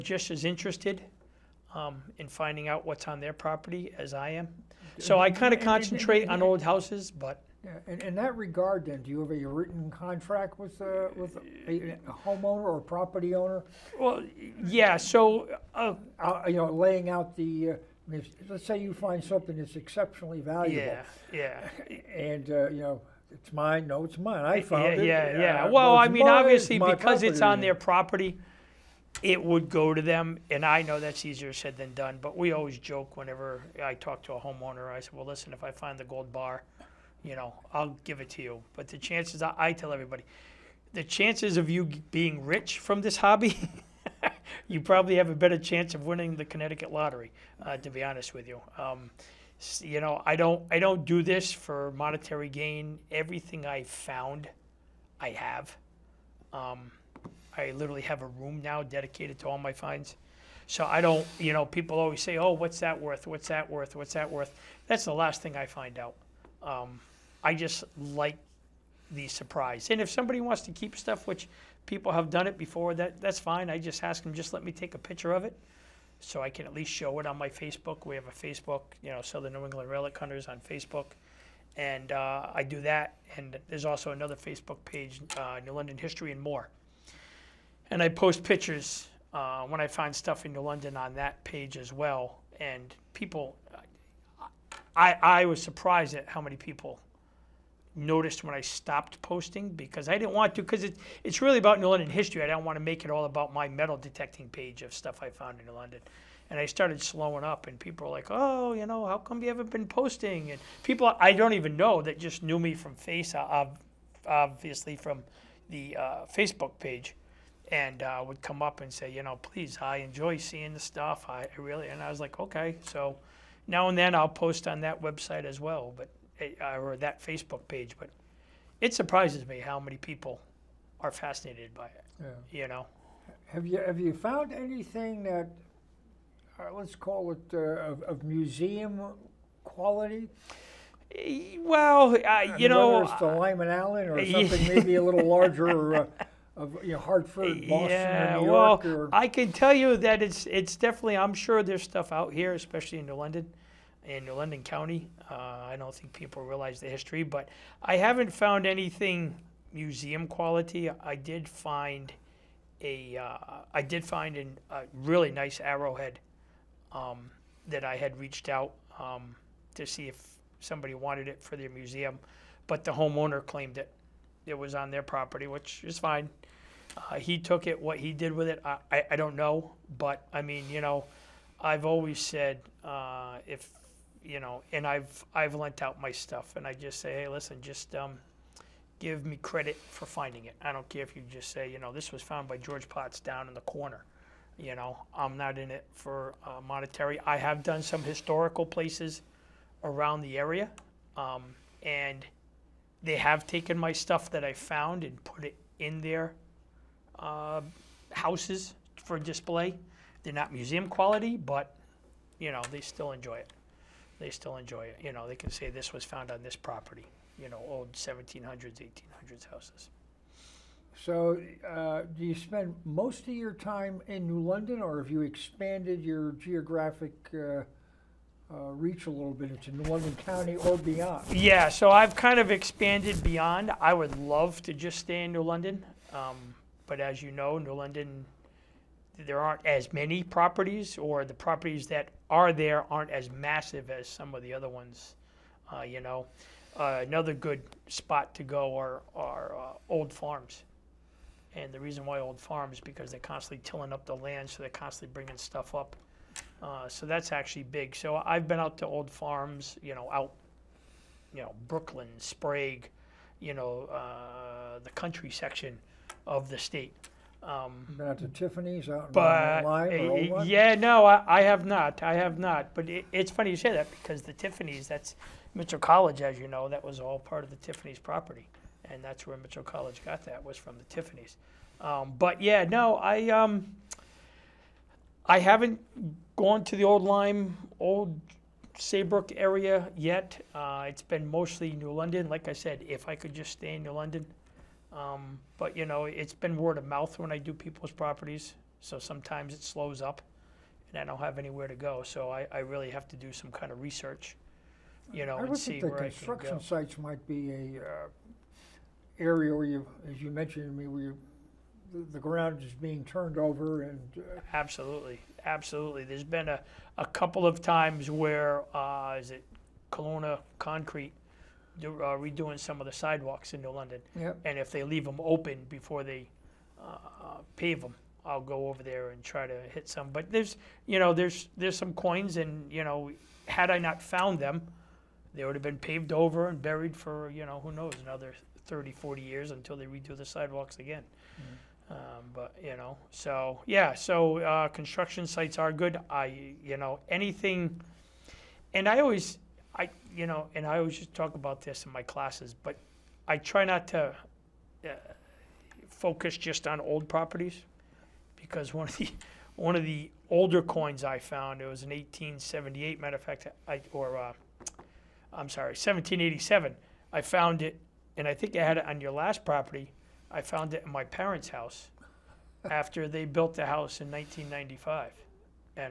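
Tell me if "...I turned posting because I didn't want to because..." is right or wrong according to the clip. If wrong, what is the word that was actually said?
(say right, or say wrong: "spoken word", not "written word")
wrong: "stopped", not "turned".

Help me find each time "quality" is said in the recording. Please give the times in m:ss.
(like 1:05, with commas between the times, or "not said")
2:19, 2:40, 3:30.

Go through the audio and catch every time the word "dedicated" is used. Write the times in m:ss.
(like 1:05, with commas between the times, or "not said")
0:58.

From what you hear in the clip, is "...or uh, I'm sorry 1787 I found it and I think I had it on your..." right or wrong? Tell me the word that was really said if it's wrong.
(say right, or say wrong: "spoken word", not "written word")
right.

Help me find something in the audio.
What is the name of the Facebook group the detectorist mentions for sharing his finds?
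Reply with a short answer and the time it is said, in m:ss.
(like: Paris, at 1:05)
Southern New England Relic Hunters, at 1:19.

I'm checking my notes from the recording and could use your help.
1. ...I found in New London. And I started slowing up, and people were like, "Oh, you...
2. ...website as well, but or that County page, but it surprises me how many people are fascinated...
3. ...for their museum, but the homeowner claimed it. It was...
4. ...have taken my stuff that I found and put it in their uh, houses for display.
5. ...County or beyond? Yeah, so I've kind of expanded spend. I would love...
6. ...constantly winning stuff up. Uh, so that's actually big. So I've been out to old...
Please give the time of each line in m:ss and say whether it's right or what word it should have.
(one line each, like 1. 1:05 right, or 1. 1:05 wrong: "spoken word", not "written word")
1. 1:45 right
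2. 2:05 wrong: "Facebook", not "County"
3. 2:51 right
4. 3:23 right
5. 3:50 wrong: "beyond", not "spend"
6. 4:14 wrong: "bringing", not "winning".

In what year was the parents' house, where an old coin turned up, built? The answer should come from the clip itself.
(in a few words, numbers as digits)
1995.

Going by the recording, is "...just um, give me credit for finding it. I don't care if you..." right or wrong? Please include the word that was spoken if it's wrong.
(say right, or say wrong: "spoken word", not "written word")
right.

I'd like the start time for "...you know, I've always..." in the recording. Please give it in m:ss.
3:00.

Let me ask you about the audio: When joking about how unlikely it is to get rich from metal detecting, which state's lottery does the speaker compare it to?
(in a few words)
Connecticut.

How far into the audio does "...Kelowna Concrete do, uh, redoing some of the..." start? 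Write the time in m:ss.
5:19.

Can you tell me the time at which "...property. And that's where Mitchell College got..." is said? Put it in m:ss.
4:37.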